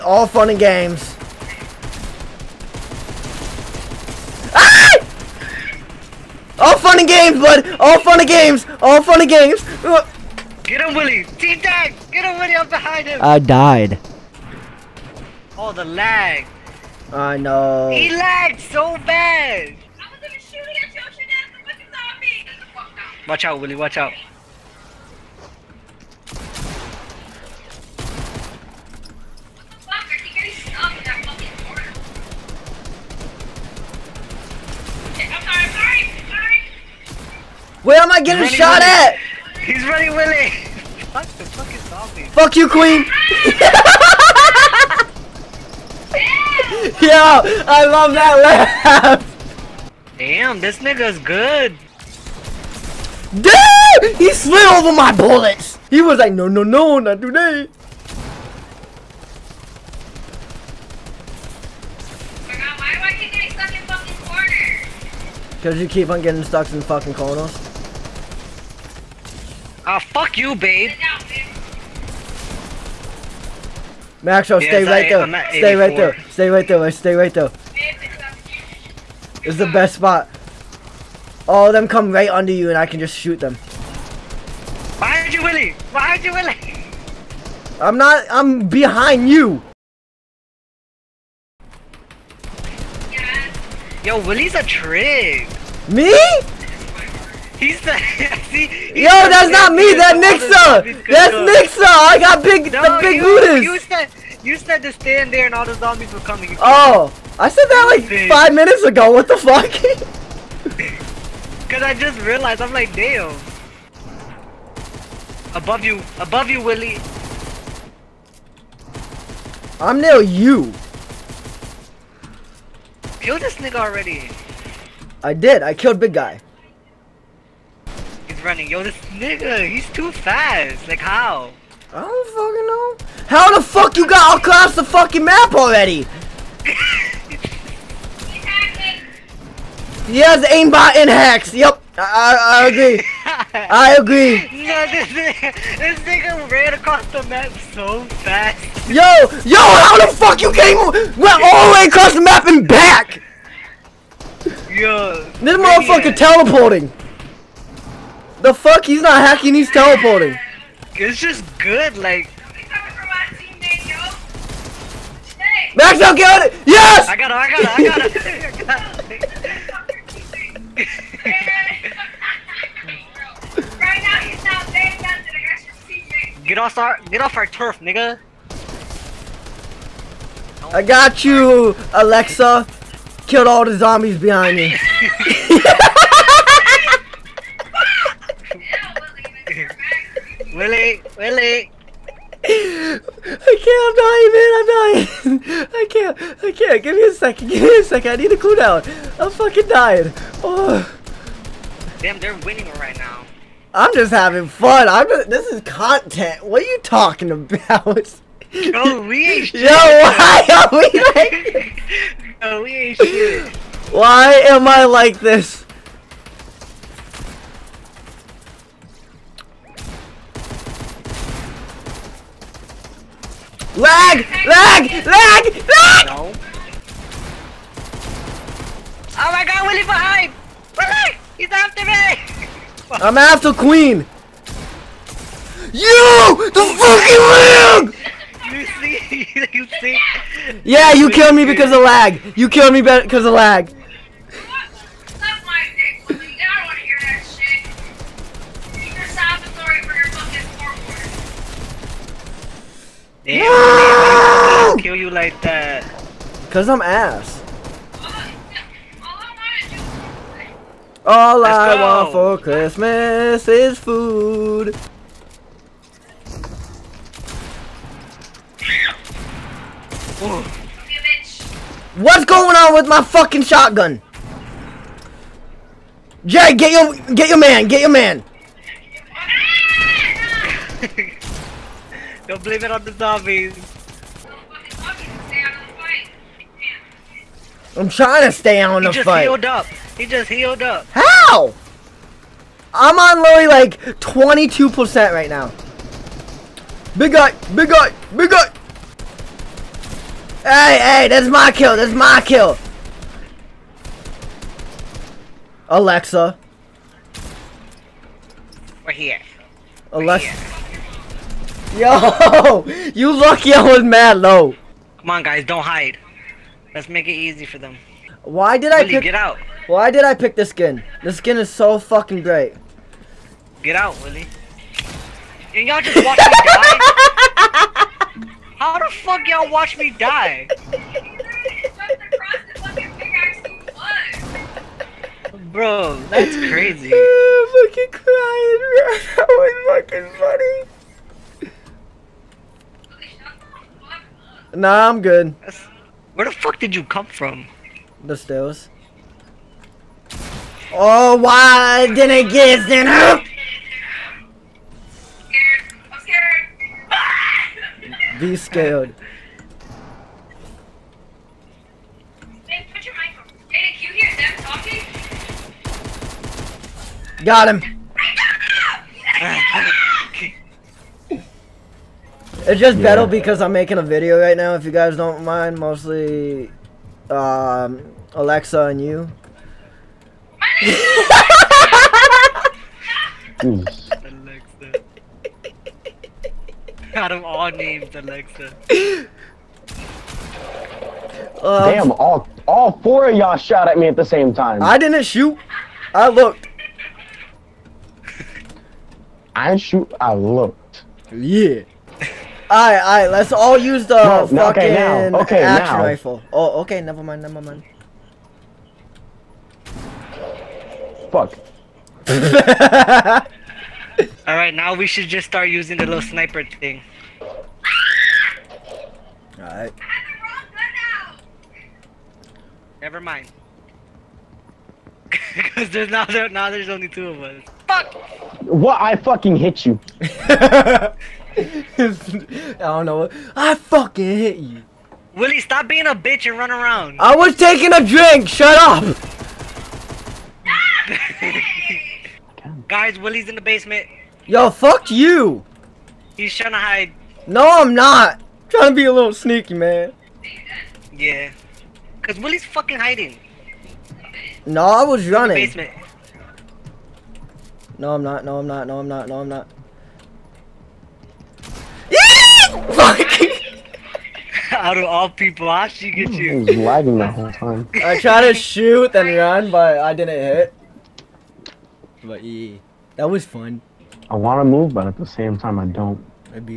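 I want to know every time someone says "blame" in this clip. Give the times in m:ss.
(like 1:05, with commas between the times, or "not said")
4:42.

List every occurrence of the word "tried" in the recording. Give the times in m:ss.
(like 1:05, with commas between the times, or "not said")
7:47.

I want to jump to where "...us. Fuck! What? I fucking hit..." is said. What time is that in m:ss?
7:07.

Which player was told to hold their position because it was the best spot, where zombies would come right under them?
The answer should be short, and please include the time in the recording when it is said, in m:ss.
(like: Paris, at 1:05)
Maxwell, at 1:14.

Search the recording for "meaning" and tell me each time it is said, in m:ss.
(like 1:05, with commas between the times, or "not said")
not said.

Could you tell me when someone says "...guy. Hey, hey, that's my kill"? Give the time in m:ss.
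4:58.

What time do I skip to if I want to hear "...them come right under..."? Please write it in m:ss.
1:21.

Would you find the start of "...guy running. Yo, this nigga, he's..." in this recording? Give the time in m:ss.
2:06.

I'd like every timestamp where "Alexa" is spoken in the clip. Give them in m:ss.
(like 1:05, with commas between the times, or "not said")
3:01, 5:05, 5:09, 6:18, 6:23, 6:27.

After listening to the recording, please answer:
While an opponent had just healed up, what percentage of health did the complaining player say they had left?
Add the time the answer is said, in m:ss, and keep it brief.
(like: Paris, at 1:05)
22%, at 4:53.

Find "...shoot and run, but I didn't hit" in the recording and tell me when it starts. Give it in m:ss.
7:48.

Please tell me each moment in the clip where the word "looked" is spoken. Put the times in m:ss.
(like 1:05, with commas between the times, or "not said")
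6:36, 6:40.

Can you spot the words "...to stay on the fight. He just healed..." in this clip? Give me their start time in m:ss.
4:48.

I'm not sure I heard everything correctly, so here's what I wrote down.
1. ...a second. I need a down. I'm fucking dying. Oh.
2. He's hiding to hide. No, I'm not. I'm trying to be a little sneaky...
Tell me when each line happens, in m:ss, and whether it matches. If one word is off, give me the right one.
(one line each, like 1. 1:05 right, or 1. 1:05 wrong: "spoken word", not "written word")
1. 3:17 right
2. 7:26 wrong: "trying", not "hiding".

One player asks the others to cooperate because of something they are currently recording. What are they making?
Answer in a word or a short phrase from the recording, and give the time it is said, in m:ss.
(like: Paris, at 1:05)
A video, at 6:13.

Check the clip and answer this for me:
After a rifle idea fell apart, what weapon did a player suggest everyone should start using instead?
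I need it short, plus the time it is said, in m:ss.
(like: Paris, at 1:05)
Little sniper, at 6:55.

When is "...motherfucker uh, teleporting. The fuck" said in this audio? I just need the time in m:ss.
2:35.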